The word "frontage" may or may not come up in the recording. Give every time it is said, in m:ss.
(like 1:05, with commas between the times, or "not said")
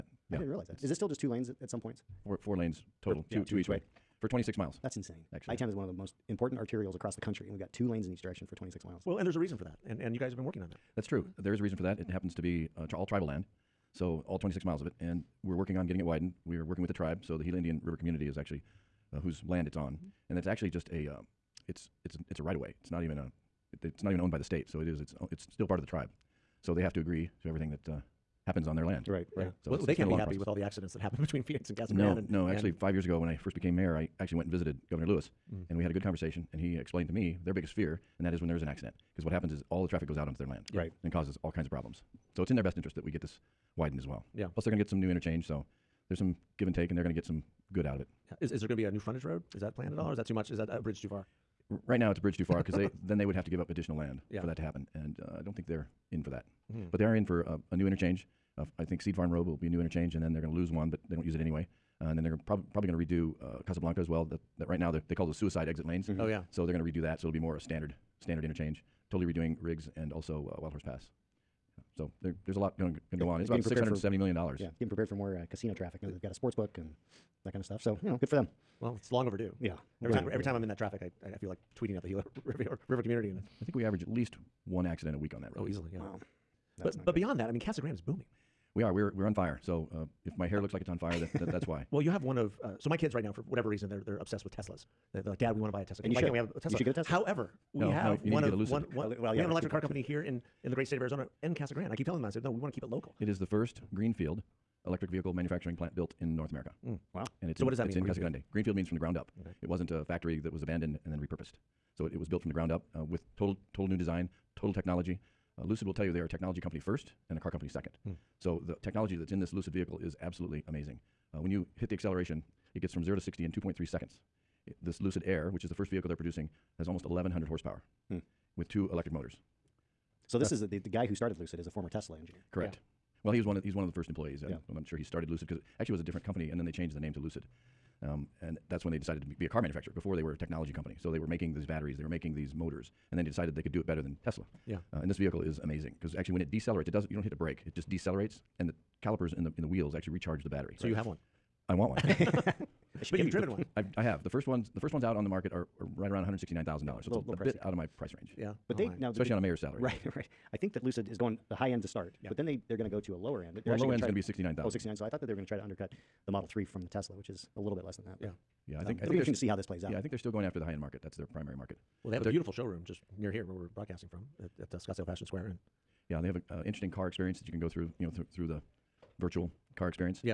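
0:48.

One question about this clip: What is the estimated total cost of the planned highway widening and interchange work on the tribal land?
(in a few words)
$670 million.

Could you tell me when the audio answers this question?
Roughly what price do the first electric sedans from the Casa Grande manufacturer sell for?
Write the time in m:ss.
2:36.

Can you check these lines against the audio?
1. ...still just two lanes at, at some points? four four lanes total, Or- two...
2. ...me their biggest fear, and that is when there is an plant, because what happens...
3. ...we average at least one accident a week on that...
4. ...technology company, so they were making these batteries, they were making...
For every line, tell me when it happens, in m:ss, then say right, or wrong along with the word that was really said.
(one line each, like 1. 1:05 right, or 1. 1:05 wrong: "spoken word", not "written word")
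1. 0:00 right
2. 0:37 wrong: "accident", not "plant"
3. 1:23 right
4. 2:20 right.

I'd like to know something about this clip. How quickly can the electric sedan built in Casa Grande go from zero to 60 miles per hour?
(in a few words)
2.3 seconds.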